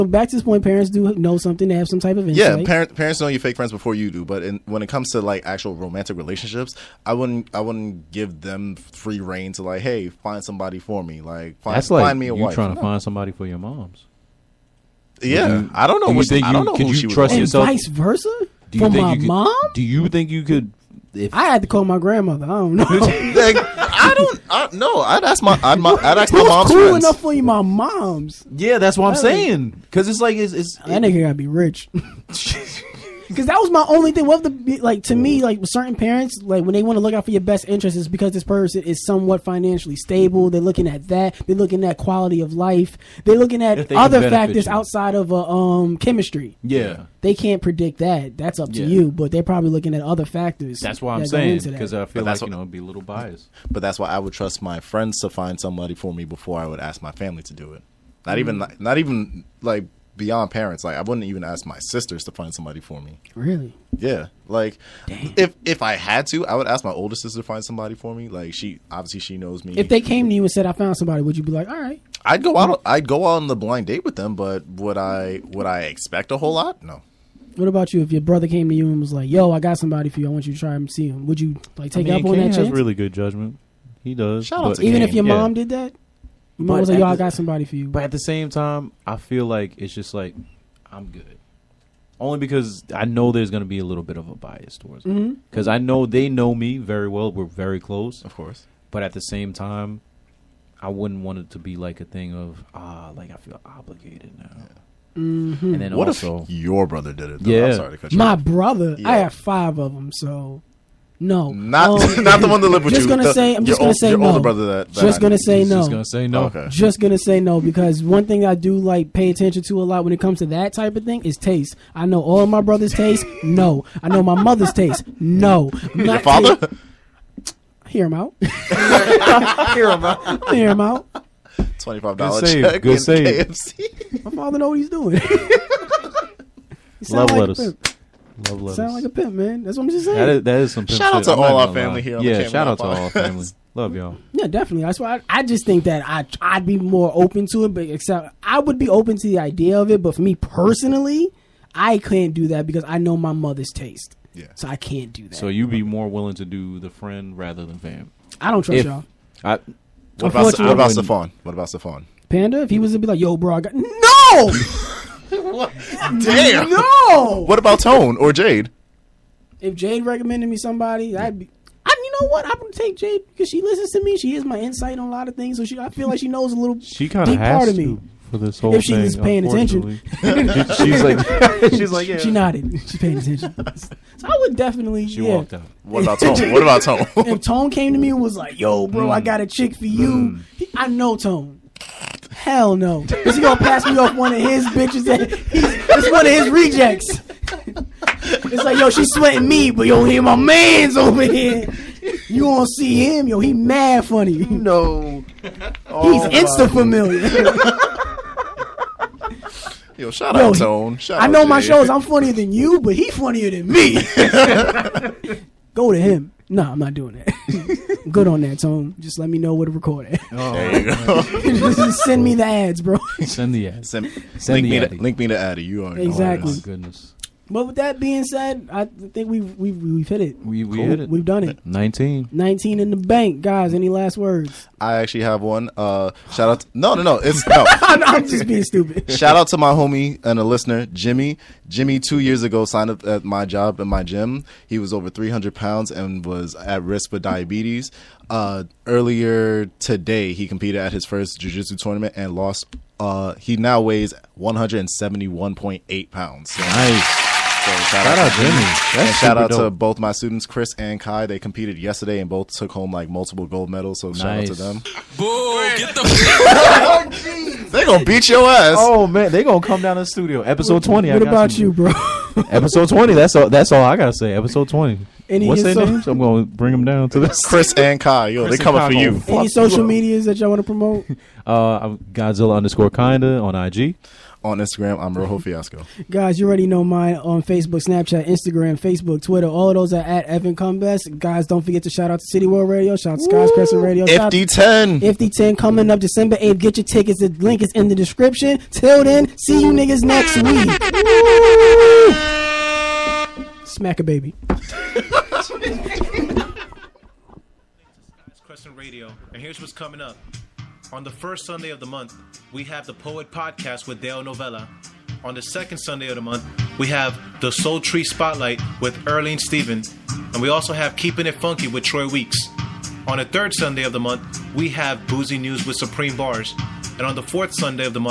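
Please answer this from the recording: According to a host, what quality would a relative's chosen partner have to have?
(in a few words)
rich.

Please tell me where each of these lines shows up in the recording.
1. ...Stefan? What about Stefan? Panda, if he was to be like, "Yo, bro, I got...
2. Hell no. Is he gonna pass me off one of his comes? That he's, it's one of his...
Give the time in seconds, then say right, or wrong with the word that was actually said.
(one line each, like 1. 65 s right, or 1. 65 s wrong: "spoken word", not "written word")
1. 160 s right
2. 192 s wrong: "bitches", not "comes".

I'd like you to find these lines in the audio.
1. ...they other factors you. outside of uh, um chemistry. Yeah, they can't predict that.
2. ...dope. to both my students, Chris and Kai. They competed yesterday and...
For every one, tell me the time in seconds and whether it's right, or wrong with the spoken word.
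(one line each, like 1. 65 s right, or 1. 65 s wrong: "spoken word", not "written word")
1. 43 s right
2. 259 s right.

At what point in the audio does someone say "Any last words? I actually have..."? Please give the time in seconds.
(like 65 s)
233 s.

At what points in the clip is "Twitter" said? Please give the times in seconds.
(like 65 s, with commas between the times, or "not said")
289 s.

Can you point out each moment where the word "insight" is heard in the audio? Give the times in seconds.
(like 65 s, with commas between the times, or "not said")
2 s, 174 s.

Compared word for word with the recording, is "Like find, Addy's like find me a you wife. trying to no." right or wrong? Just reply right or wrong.
wrong.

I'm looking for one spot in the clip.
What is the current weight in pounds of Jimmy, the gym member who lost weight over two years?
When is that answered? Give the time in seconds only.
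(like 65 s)
254 s.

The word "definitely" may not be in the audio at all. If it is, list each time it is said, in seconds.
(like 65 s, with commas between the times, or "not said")
144 s, 184 s.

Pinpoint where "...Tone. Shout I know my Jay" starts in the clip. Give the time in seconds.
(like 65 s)
210 s.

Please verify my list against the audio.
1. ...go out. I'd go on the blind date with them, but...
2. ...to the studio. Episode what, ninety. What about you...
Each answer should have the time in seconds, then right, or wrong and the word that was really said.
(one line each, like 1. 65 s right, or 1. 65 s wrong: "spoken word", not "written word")
1. 72 s right
2. 269 s wrong: "twenty", not "ninety".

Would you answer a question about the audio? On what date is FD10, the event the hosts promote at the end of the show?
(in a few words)
December 8th.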